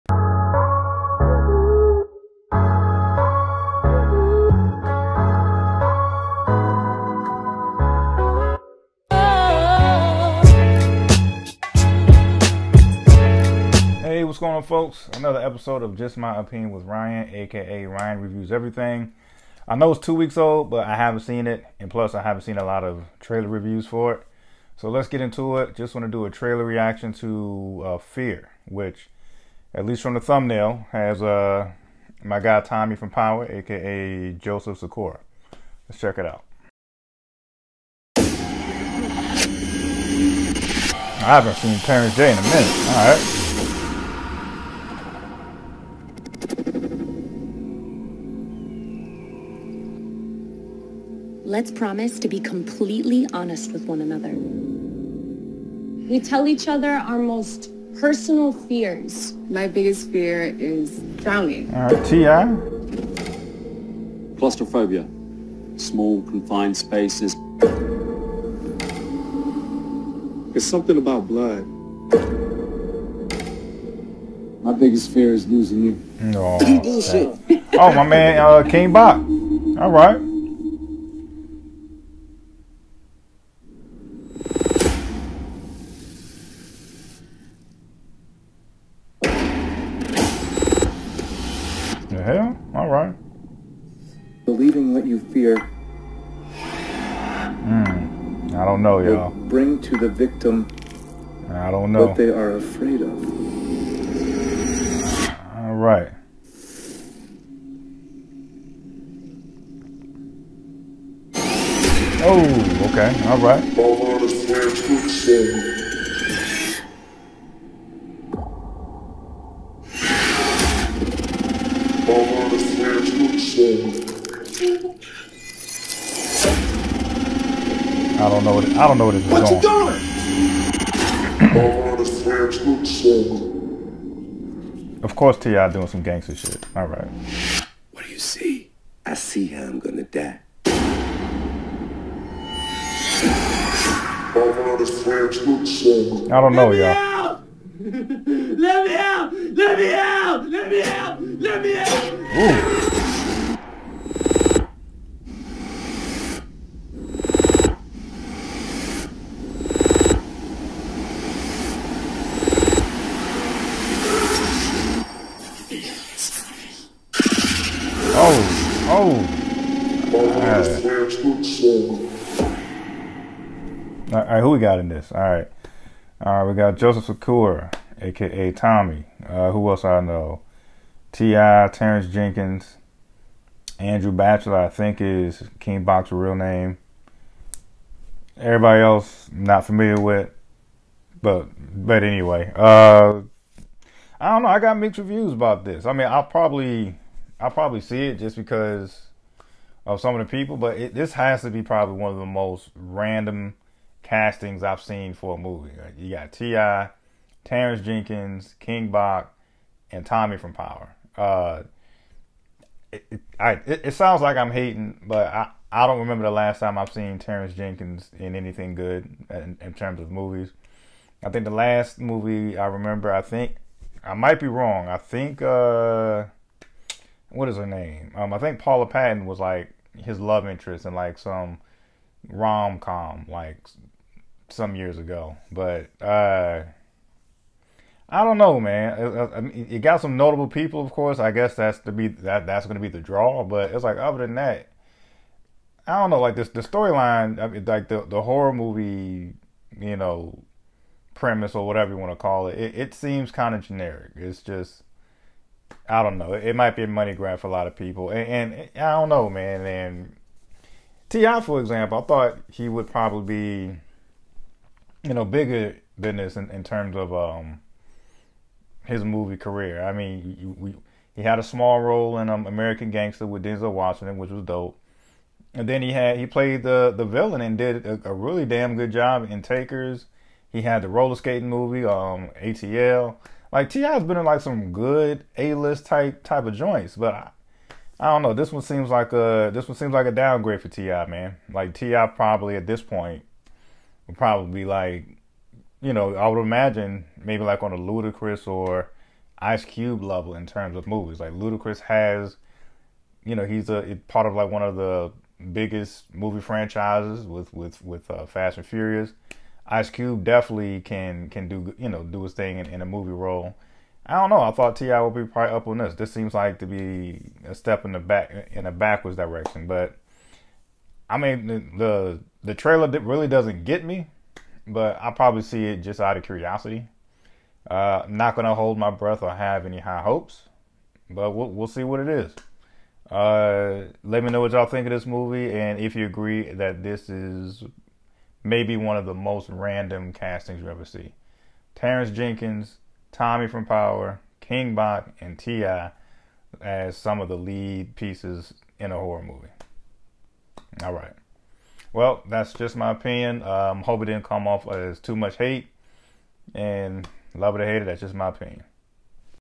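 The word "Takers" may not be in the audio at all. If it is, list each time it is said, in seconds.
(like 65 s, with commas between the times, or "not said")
279 s.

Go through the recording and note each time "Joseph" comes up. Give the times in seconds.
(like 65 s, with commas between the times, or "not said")
34 s, 176 s.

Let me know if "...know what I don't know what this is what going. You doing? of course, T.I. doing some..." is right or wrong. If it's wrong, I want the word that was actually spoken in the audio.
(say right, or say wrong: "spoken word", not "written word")
right.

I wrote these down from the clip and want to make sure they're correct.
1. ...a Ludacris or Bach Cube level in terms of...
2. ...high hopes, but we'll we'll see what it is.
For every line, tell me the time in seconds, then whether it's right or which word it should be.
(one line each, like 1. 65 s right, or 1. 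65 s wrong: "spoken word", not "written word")
1. 297 s wrong: "Ice", not "Bach"
2. 329 s right.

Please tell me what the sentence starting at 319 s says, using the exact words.
But I mean, the the, the trailer really doesn't get me, but I probably see it just out of curiosity.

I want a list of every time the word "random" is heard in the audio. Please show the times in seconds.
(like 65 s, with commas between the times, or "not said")
202 s, 339 s.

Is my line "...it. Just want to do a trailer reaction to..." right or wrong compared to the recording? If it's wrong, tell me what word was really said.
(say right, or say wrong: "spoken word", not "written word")
right.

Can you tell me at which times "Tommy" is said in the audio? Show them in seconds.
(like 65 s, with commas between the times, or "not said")
32 s, 178 s, 210 s, 343 s.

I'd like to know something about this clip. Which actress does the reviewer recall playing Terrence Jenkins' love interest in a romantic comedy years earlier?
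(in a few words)
Paula Patton.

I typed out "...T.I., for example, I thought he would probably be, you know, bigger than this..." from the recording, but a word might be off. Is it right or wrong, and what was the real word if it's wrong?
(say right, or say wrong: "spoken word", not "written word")
right.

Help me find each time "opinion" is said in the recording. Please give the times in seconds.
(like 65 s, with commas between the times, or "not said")
16 s, 352 s, 358 s.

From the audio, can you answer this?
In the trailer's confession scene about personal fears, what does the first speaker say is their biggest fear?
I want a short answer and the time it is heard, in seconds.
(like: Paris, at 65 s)
Drowning, at 61 s.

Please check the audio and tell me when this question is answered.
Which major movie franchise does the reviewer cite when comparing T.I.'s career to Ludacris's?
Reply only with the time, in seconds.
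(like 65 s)
308 s.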